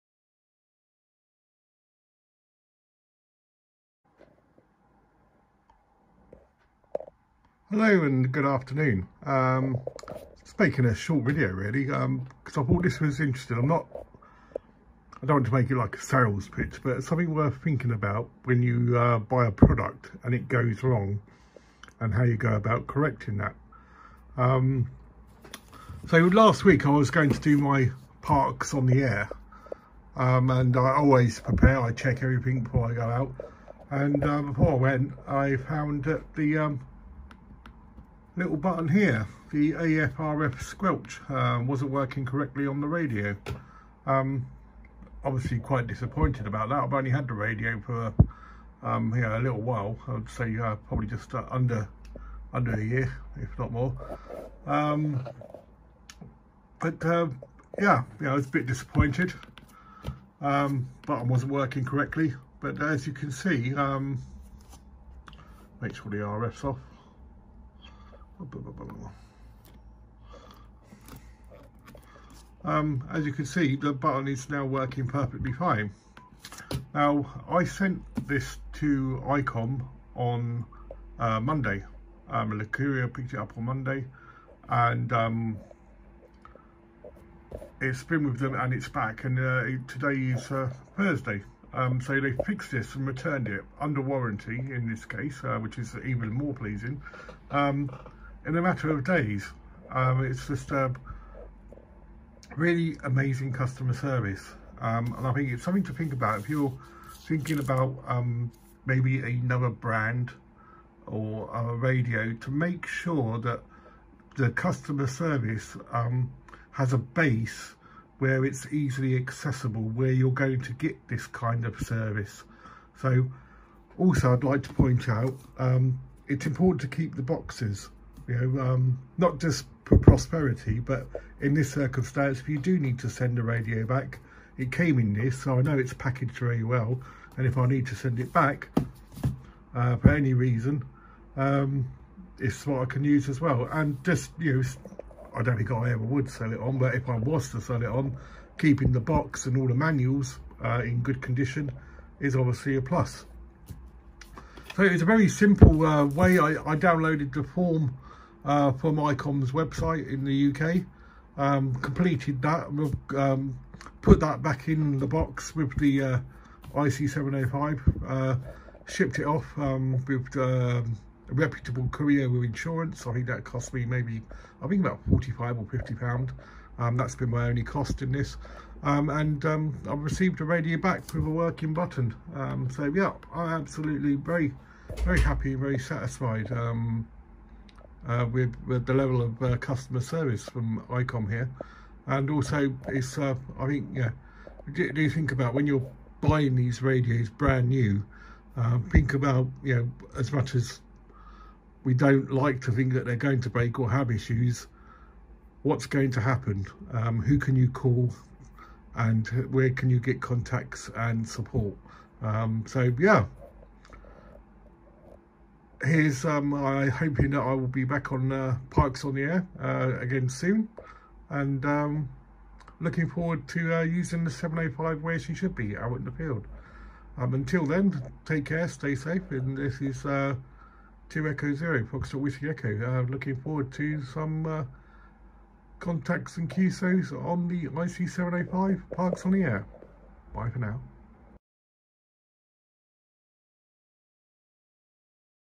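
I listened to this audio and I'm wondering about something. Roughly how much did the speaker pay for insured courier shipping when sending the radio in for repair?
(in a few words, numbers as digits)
45 or 50 pounds.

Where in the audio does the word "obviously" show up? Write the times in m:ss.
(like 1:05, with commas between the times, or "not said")
0:45, 2:32.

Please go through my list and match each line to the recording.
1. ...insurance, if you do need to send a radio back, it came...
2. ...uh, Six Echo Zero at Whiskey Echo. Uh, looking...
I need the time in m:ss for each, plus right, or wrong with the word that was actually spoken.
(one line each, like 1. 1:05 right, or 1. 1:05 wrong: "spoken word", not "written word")
1. 2:11 wrong: "circumstance", not "insurance"
2. 3:50 wrong: "Two", not "Six".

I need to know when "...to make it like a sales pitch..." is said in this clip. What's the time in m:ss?
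0:15.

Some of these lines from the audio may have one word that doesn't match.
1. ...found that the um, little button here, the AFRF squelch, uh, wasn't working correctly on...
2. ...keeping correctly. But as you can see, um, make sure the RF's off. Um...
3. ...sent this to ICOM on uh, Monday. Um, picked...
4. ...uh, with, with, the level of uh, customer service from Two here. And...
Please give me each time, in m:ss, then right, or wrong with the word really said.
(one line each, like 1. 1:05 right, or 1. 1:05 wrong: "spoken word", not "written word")
1. 0:35 right
2. 1:01 wrong: "working", not "keeping"
3. 1:17 right
4. 3:08 wrong: "ICOM", not "Two".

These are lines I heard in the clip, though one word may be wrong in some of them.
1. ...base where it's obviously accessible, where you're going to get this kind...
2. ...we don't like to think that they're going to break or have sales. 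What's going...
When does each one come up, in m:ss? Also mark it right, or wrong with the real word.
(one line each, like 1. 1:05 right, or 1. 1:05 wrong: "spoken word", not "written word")
1. 1:56 wrong: "easily", not "obviously"
2. 3:21 wrong: "issues", not "sales".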